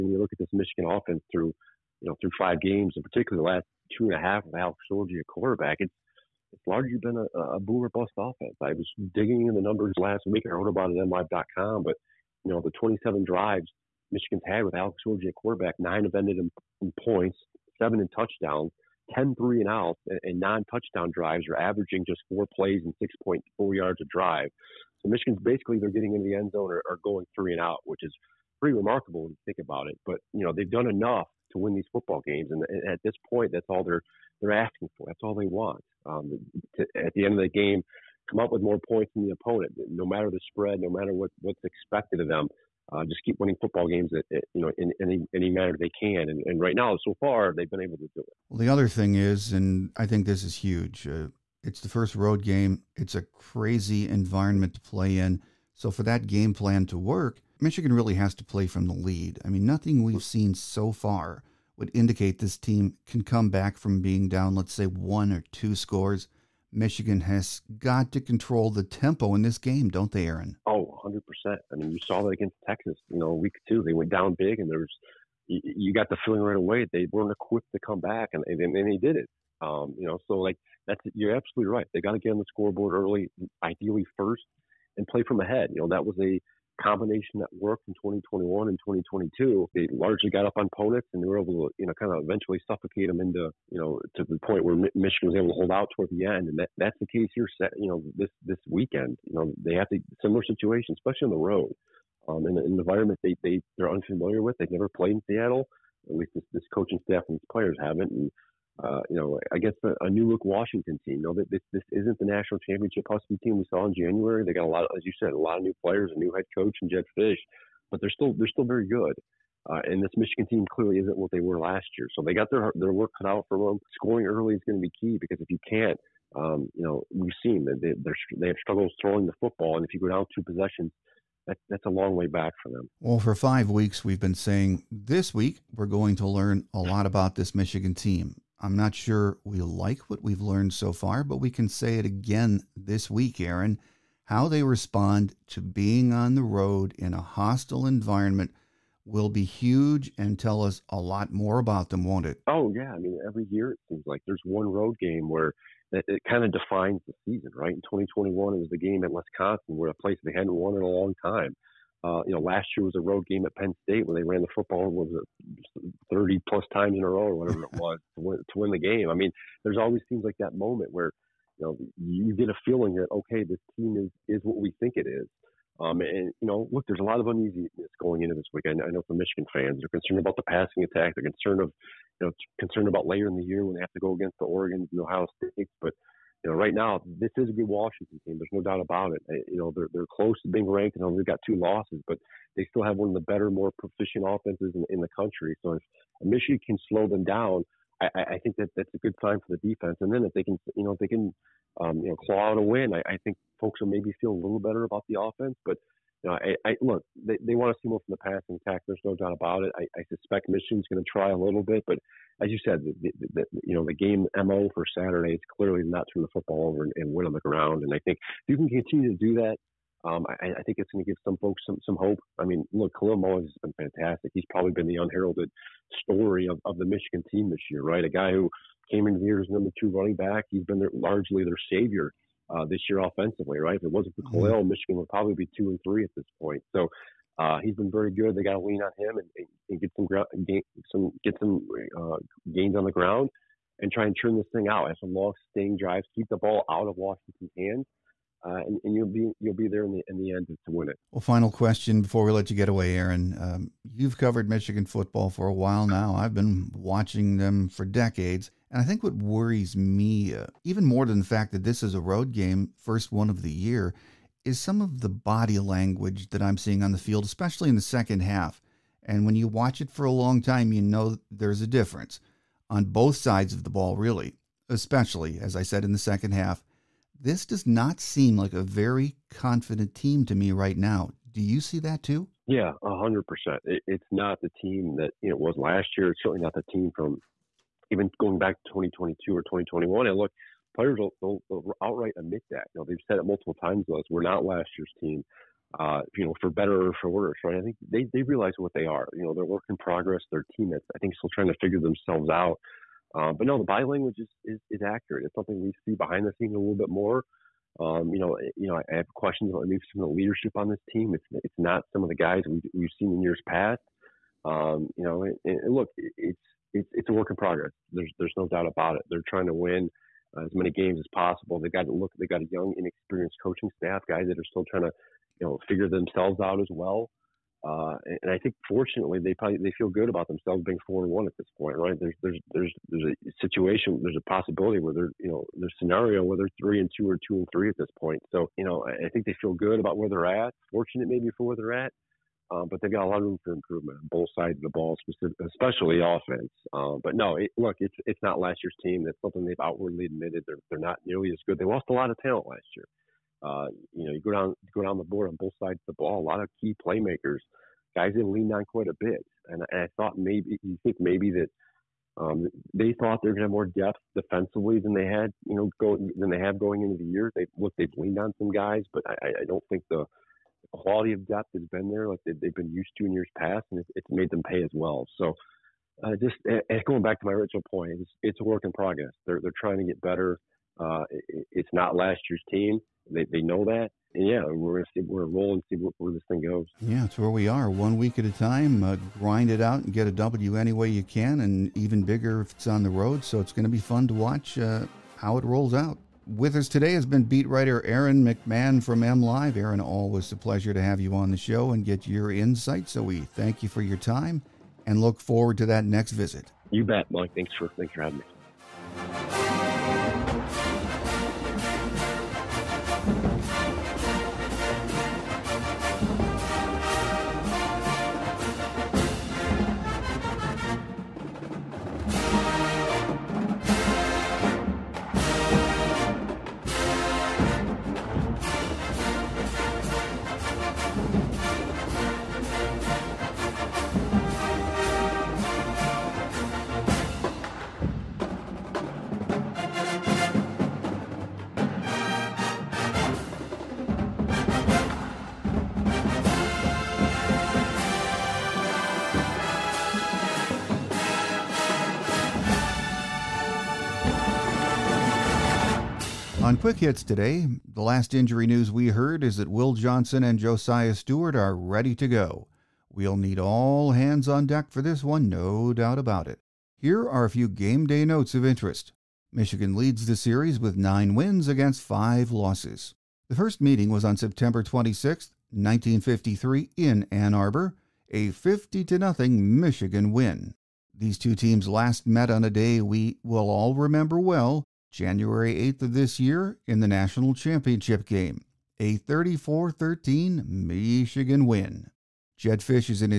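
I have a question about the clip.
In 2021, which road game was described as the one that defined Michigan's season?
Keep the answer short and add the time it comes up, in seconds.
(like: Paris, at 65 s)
Wisconsin, at 159 s.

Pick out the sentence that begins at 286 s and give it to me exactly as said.
It's certainly not the team from even going back to 2022 or 2021, and look, players will, will, will outright admit that.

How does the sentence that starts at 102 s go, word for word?
Um, in, in an environment they, they, they're unfamiliar with.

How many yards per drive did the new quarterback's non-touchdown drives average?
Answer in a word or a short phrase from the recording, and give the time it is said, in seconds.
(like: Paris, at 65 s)
6.4 yards, at 23 s.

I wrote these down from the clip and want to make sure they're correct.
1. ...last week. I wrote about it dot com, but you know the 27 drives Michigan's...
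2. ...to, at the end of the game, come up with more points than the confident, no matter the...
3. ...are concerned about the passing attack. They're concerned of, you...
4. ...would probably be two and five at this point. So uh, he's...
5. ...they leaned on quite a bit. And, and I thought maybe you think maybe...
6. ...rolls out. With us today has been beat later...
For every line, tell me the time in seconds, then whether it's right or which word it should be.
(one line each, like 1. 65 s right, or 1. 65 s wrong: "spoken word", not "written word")
1. 9 s right
2. 36 s wrong: "opponent", not "confident"
3. 179 s right
4. 234 s wrong: "three", not "five"
5. 358 s right
6. 395 s wrong: "writer", not "later".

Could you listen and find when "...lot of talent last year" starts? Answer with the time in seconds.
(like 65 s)
351 s.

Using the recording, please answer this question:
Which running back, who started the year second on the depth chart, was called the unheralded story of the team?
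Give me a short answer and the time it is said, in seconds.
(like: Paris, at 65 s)
Kalel Mullings, at 222 s.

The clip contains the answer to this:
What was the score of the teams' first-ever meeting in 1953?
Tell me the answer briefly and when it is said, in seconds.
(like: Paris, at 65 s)
50-0, at 478 s.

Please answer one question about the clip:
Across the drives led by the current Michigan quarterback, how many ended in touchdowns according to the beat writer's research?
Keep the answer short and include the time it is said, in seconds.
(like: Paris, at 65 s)
7, at 17 s.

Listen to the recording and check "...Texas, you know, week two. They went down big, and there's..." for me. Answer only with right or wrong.
right.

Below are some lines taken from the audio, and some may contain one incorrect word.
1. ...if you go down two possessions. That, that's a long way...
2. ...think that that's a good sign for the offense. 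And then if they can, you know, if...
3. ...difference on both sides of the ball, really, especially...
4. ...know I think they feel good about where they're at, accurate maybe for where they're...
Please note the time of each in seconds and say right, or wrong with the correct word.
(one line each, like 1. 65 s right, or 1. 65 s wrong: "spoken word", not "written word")
1. 129 s right
2. 198 s wrong: "defense", not "offense"
3. 271 s right
4. 338 s wrong: "fortunate", not "accurate".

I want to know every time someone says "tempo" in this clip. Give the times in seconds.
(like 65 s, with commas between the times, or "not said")
68 s.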